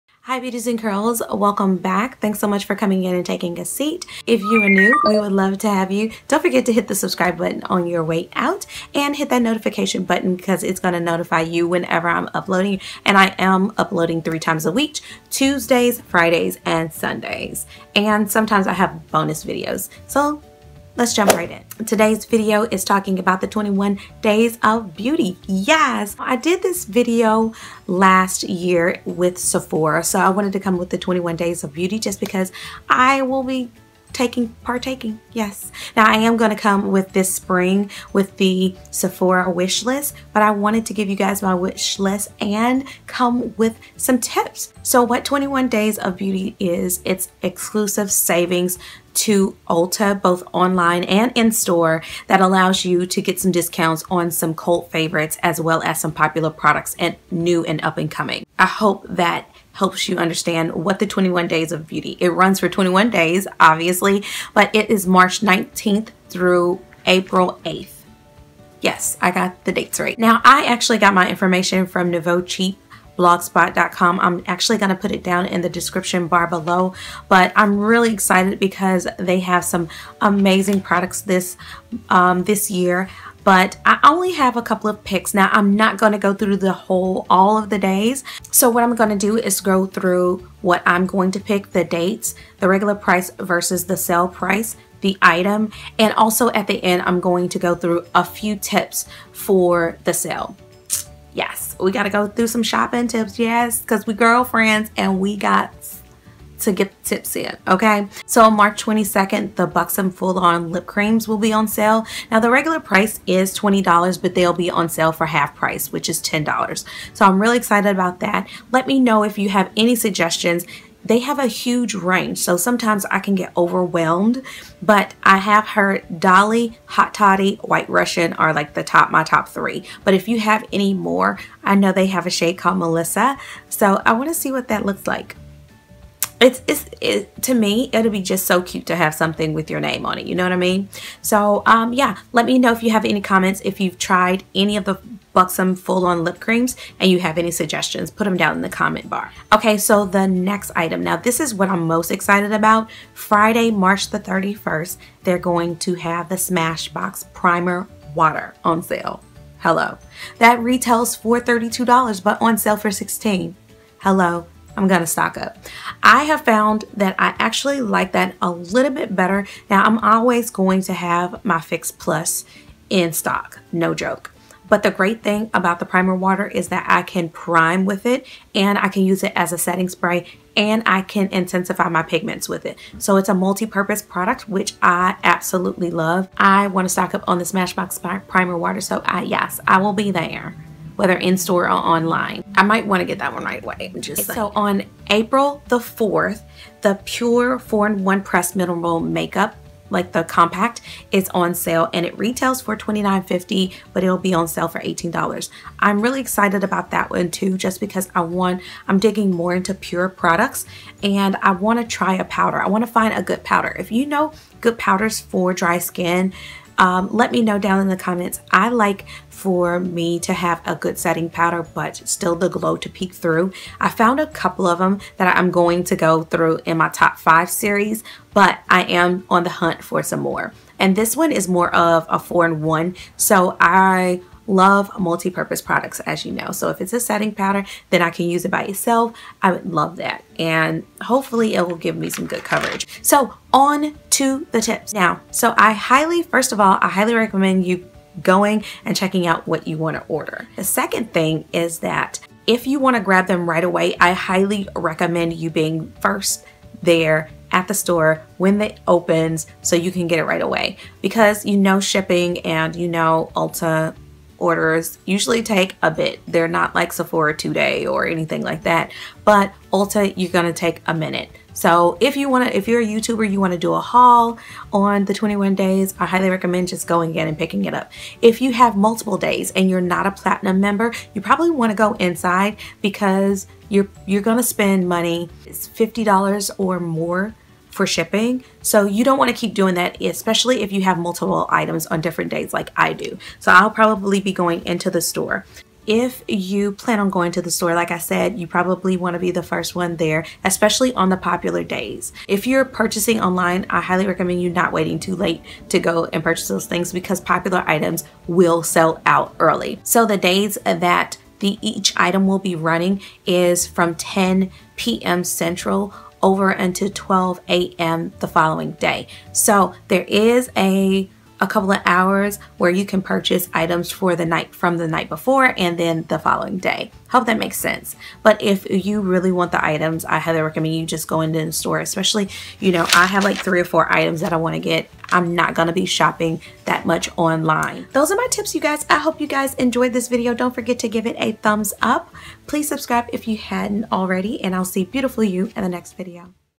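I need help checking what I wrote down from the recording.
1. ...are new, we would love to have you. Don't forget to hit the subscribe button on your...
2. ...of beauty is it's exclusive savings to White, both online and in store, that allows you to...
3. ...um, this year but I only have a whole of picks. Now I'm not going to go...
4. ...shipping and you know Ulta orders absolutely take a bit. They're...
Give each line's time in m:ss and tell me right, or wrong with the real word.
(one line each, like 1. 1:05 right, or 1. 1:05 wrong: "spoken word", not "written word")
1. 0:04 right
2. 0:45 wrong: "Ulta", not "White"
3. 1:22 wrong: "couple", not "whole"
4. 4:21 wrong: "usually", not "absolutely".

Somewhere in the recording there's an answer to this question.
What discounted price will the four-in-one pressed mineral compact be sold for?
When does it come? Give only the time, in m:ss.
3:24.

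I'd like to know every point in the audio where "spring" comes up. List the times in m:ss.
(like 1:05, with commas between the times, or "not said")
0:37.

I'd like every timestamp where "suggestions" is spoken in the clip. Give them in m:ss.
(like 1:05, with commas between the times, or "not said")
1:59, 2:27.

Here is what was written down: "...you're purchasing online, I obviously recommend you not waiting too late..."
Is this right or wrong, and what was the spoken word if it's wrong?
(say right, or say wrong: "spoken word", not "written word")
wrong: "highly", not "obviously".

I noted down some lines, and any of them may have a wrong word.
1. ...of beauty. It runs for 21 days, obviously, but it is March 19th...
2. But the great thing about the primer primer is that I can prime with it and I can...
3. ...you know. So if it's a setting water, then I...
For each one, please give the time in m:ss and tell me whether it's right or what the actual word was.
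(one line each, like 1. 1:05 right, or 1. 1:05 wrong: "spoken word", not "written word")
1. 1:01 right
2. 2:54 wrong: "water", not "primer"
3. 3:56 wrong: "powder", not "water".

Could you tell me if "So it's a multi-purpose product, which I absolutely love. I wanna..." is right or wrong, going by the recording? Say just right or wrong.
right.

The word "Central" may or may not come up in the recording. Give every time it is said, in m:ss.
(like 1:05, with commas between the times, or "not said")
5:15.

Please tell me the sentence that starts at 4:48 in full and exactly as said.
So you don't want to keep doing that, especially if you have multiple items on different days like I do.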